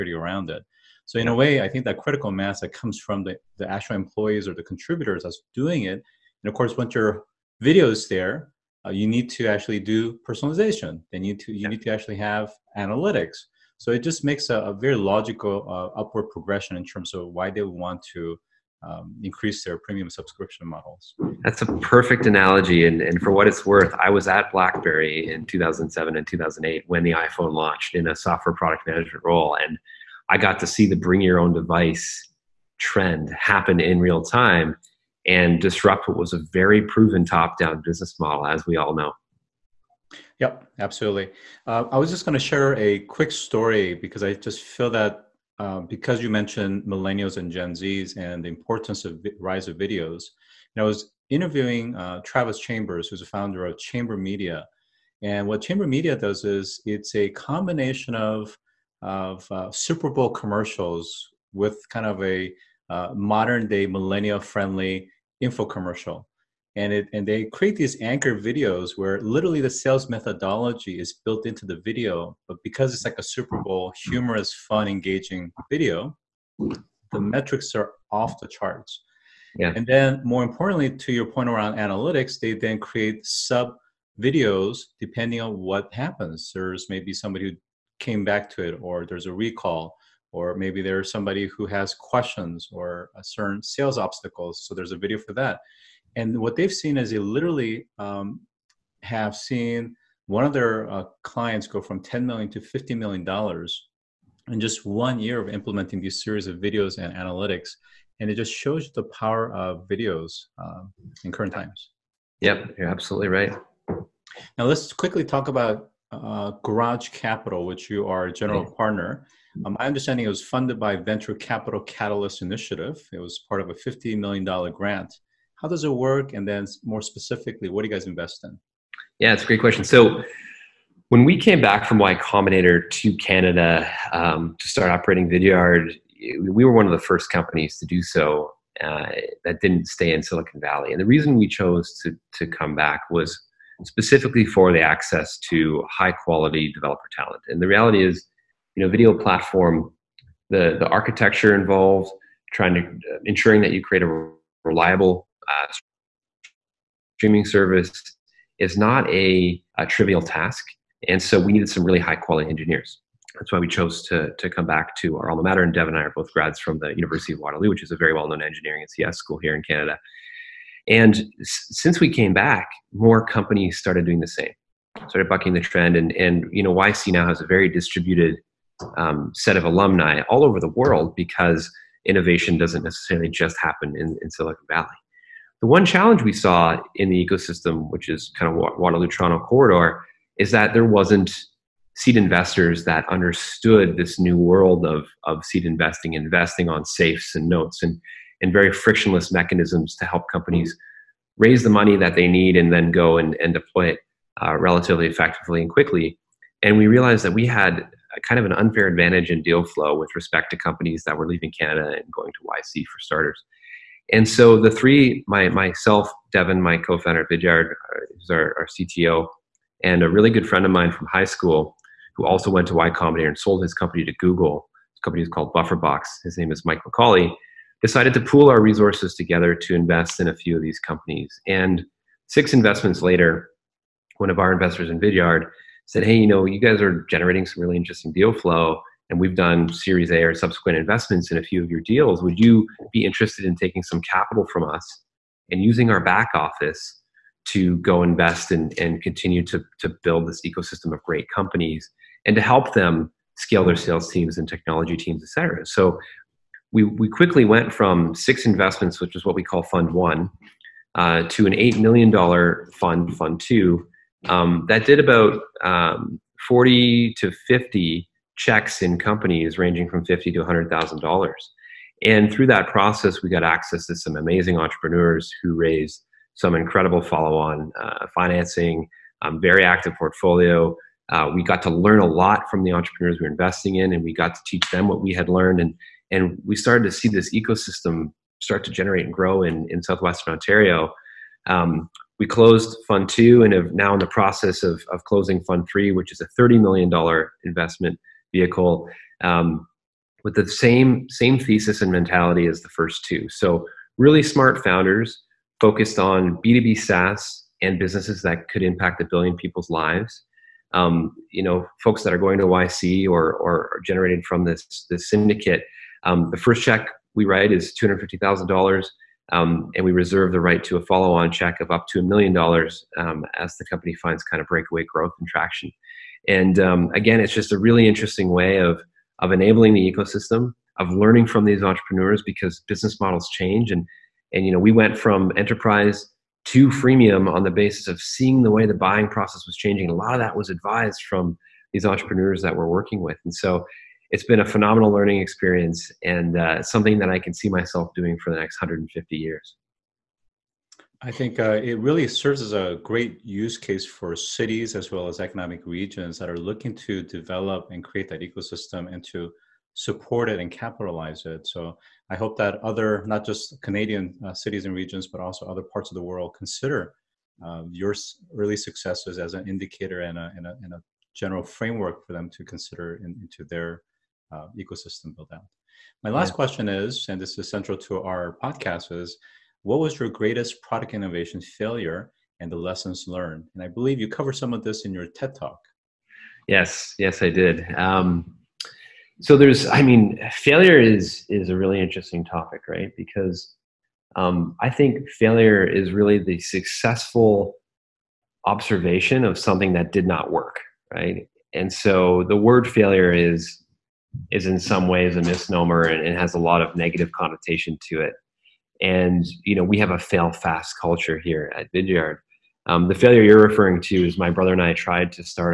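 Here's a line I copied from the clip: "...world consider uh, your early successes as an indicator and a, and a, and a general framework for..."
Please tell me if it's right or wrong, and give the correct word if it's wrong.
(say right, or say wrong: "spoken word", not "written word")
right.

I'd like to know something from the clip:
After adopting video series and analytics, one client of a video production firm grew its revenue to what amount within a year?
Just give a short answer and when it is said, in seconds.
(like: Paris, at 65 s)
$50 million, at 102 s.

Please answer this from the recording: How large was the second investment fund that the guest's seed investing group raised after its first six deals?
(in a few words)
$8 million.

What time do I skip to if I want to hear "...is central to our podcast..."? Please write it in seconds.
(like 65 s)
377 s.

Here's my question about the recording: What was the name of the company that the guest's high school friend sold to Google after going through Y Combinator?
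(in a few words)
BufferBox.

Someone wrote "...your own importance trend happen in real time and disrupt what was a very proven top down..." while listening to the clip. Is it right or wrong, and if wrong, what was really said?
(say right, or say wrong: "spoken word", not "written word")
wrong: "device", not "importance".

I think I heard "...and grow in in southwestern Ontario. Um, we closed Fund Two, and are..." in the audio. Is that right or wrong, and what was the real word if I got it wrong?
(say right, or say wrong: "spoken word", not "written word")
right.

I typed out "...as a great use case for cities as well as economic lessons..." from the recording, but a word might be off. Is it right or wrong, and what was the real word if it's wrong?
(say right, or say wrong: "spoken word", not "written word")
wrong: "regions", not "lessons".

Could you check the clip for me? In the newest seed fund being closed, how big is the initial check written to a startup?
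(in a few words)
$250,000.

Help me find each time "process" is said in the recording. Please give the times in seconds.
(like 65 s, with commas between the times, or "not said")
272 s, 294 s, 339 s.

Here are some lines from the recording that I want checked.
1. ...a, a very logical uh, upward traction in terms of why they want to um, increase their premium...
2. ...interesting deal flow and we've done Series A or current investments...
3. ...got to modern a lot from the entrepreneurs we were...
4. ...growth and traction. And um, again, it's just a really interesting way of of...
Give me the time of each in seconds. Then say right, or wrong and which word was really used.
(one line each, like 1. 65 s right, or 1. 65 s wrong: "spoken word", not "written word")
1. 14 s wrong: "progression", not "traction"
2. 237 s wrong: "subsequent", not "current"
3. 281 s wrong: "learn", not "modern"
4. 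324 s right.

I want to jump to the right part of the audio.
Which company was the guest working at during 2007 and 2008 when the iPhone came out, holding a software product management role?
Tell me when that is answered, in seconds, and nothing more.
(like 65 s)
24 s.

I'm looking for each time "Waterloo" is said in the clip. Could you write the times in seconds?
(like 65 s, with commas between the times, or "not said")
167 s, 188 s.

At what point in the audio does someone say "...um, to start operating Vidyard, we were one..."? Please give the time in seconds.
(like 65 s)
134 s.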